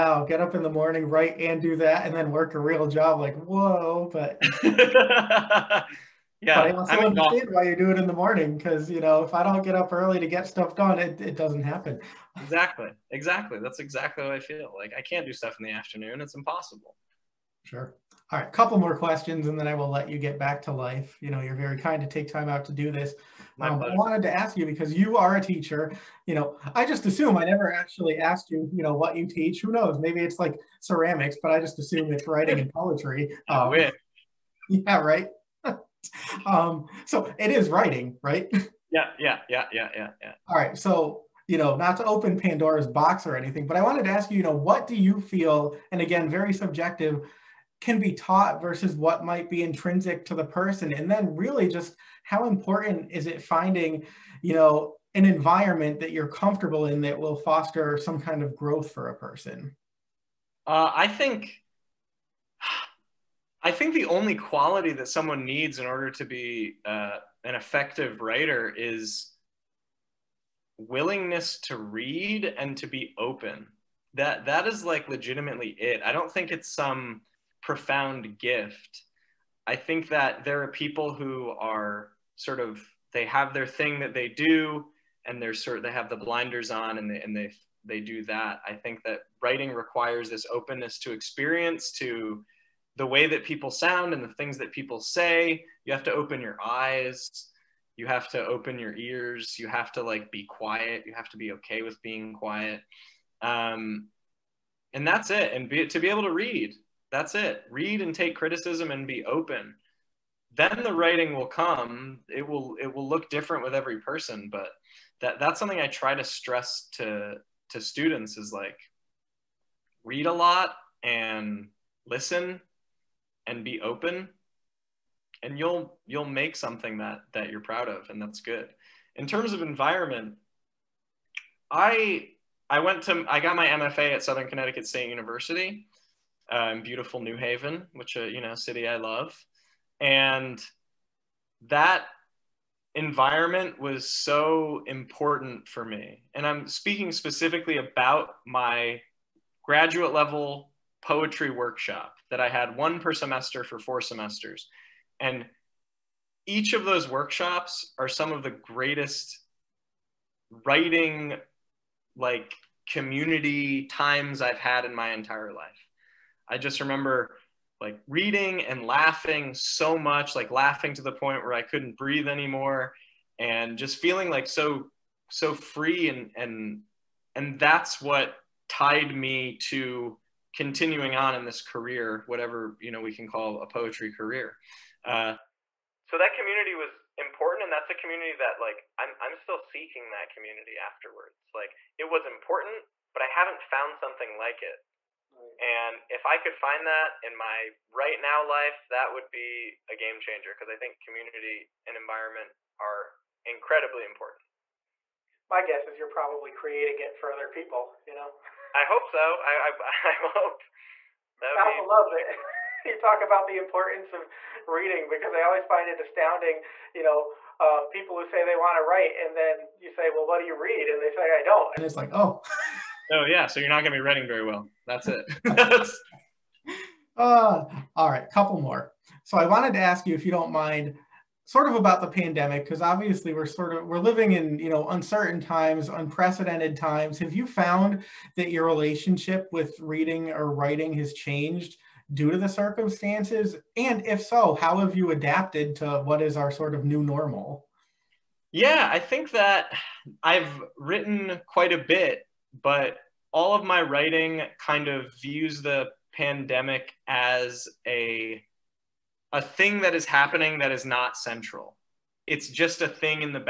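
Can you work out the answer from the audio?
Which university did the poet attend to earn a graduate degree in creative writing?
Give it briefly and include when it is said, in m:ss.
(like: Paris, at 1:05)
Southern Connecticut State University, at 2:14.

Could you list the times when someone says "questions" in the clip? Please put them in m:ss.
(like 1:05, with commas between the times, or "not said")
0:18.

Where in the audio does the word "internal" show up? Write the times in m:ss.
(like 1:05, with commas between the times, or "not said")
not said.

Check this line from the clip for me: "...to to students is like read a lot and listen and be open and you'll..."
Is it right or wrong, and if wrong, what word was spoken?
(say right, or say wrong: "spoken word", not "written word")
right.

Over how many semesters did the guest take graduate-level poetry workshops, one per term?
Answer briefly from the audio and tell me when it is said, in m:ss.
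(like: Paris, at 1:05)
4, at 2:33.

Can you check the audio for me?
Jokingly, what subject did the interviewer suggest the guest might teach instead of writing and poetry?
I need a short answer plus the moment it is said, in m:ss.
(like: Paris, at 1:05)
Ceramics, at 0:30.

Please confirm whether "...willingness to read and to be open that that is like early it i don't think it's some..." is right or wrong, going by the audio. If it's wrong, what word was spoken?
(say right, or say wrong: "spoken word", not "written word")
wrong: "legitimately", not "early".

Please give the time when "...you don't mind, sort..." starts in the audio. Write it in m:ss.
3:50.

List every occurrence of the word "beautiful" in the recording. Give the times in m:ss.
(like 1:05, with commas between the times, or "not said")
2:16.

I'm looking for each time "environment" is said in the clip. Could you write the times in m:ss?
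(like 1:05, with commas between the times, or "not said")
0:55, 2:09, 2:22, 3:21.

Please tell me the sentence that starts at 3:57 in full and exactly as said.
Have you found that your relationship with reading or writing has changed due to the circumstances?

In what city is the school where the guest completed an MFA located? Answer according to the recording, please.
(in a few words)
New Haven.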